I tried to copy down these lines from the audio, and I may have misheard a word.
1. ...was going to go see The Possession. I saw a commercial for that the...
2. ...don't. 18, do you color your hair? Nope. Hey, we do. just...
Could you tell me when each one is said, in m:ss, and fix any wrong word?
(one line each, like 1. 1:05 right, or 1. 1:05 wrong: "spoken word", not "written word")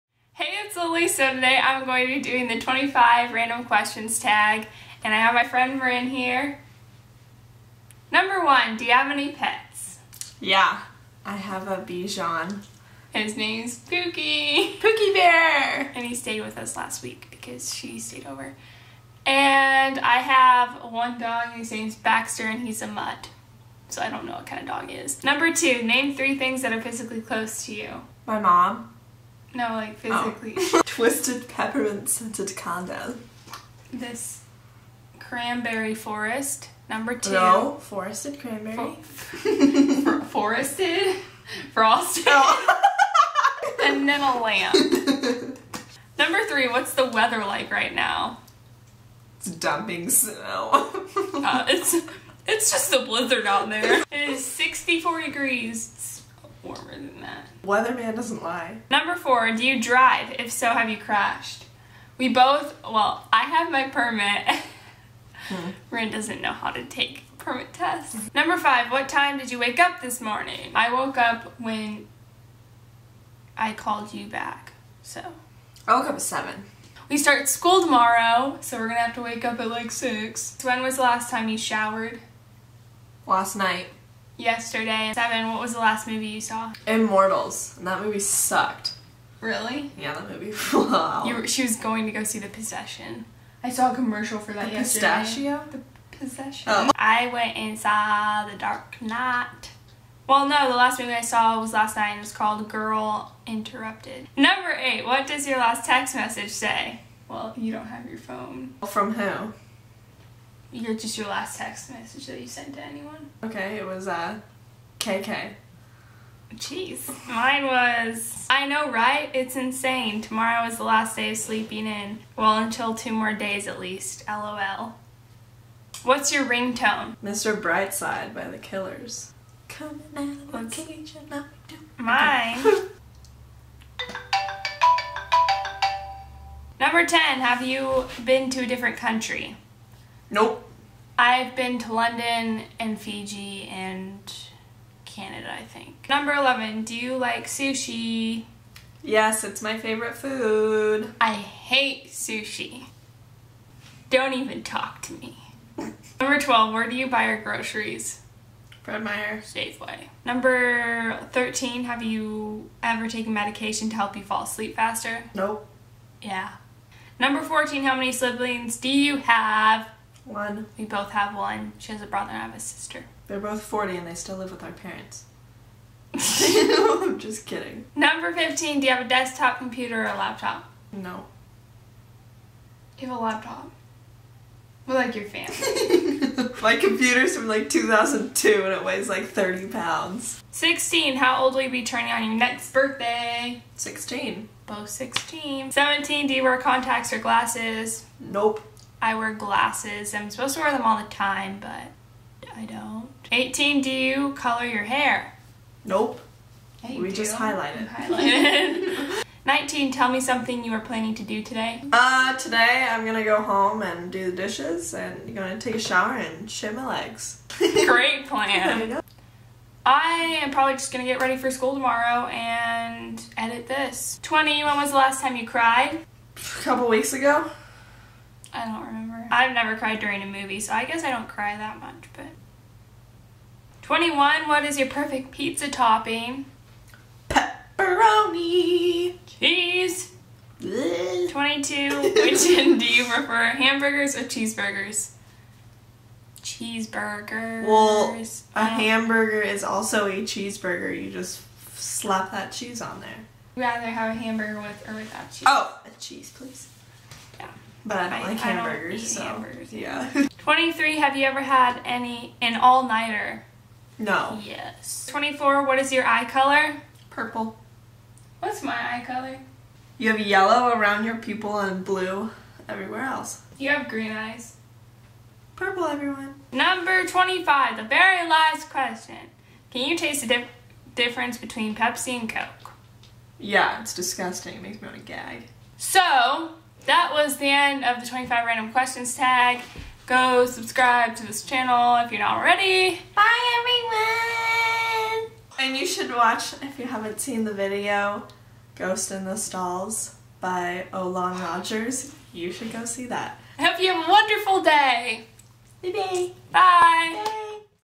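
1. 1:31 right
2. 3:22 right.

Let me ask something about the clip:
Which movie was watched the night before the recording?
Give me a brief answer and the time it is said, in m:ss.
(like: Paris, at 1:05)
Girl Interrupted, at 1:42.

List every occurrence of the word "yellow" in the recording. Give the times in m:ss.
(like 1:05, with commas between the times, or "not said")
4:30.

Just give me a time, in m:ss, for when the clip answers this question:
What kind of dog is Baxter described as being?
0:22.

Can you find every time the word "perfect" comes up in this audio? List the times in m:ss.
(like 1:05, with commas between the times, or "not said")
3:54.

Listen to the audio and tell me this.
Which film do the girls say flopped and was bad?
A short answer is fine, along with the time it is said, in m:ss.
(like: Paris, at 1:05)
Immortals, at 1:26.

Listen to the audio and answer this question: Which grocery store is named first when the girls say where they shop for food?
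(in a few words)
Fred Meyer.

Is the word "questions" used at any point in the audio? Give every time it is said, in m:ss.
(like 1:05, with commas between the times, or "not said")
0:03, 4:38, 4:48.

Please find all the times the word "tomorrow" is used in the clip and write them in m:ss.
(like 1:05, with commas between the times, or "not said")
1:17, 2:00, 3:41.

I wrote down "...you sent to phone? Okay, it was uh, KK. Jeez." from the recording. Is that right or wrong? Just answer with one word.
wrong.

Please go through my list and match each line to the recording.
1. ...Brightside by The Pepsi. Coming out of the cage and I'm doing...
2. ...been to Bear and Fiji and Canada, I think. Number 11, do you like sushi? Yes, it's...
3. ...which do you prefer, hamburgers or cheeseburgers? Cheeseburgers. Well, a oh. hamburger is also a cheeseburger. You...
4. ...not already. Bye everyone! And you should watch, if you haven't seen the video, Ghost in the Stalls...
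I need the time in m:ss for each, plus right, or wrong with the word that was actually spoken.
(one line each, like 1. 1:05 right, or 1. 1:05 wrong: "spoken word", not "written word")
1. 2:07 wrong: "Killers", not "Pepsi"
2. 2:21 wrong: "London", not "Bear"
3. 4:02 right
4. 4:52 right.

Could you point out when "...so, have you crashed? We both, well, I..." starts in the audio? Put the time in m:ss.
1:00.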